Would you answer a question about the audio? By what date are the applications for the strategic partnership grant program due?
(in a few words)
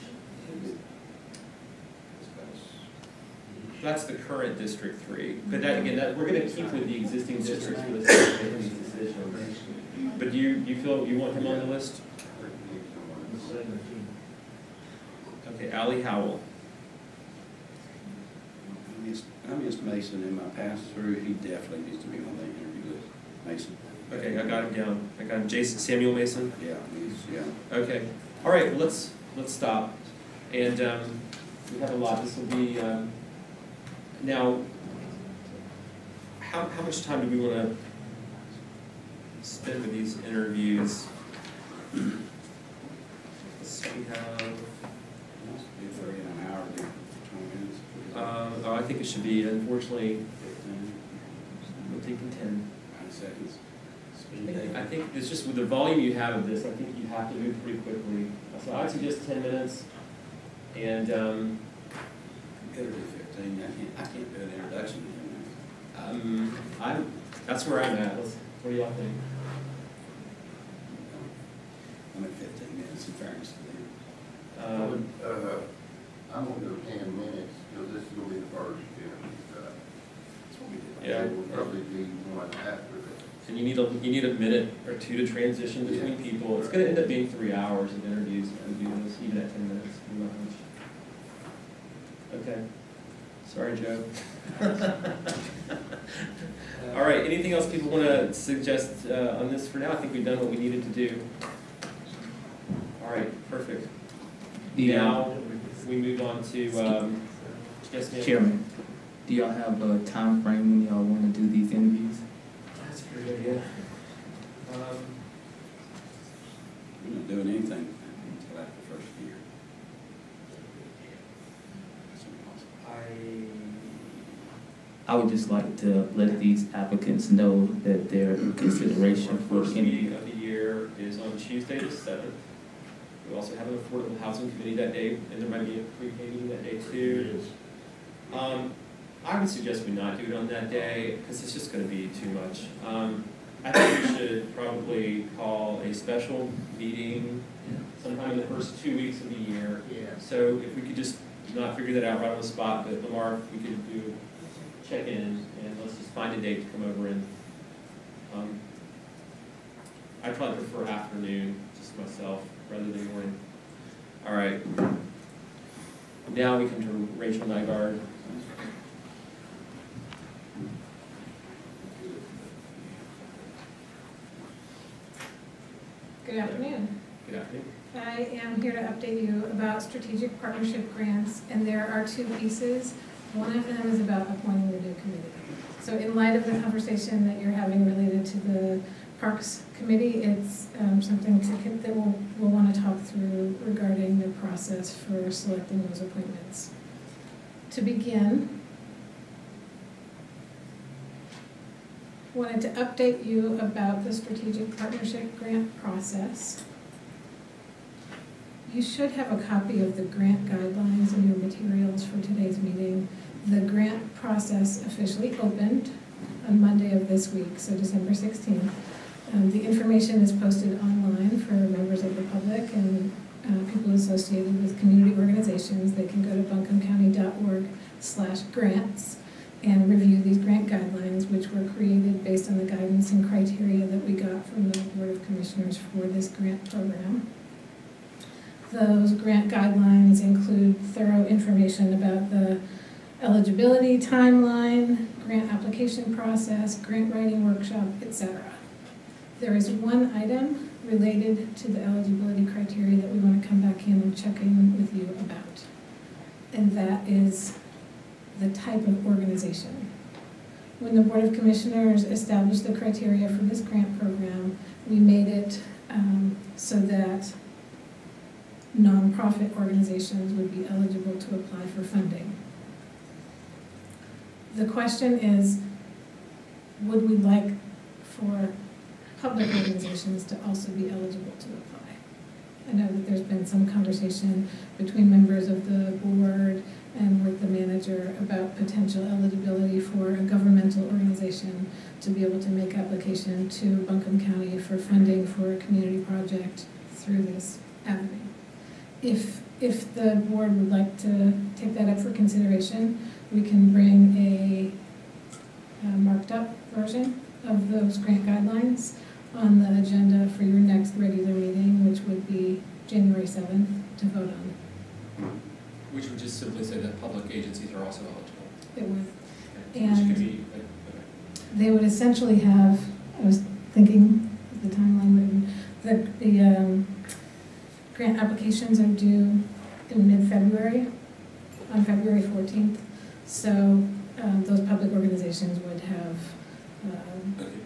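February 14th.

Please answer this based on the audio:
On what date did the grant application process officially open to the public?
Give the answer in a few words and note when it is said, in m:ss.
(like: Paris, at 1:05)
December 16th, at 3:37.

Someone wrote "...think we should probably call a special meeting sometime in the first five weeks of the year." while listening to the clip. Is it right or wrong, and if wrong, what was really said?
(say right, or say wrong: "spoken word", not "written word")
wrong: "two", not "five".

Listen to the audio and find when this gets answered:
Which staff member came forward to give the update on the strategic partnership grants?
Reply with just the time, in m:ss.
2:47.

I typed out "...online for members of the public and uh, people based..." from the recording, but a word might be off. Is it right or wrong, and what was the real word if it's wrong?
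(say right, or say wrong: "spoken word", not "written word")
wrong: "associated", not "based".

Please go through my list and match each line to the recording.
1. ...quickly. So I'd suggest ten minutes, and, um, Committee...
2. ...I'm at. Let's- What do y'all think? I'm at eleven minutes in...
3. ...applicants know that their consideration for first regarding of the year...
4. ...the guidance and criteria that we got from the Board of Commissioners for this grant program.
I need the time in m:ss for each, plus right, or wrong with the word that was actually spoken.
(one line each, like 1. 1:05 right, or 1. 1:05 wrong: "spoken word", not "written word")
1. 0:57 wrong: "Better", not "Committee"
2. 1:07 wrong: "fifteen", not "eleven"
3. 2:06 wrong: "meeting", not "regarding"
4. 3:52 right.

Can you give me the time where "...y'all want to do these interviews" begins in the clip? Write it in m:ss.
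1:50.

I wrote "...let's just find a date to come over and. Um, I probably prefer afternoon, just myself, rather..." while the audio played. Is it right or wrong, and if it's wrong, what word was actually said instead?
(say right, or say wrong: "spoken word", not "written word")
right.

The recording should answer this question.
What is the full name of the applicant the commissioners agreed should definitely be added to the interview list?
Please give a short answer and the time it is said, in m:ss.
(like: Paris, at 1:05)
Jason Samuel Mason, at 0:25.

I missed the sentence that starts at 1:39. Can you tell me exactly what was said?
I think we've done what we needed to do.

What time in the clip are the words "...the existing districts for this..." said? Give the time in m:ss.
0:06.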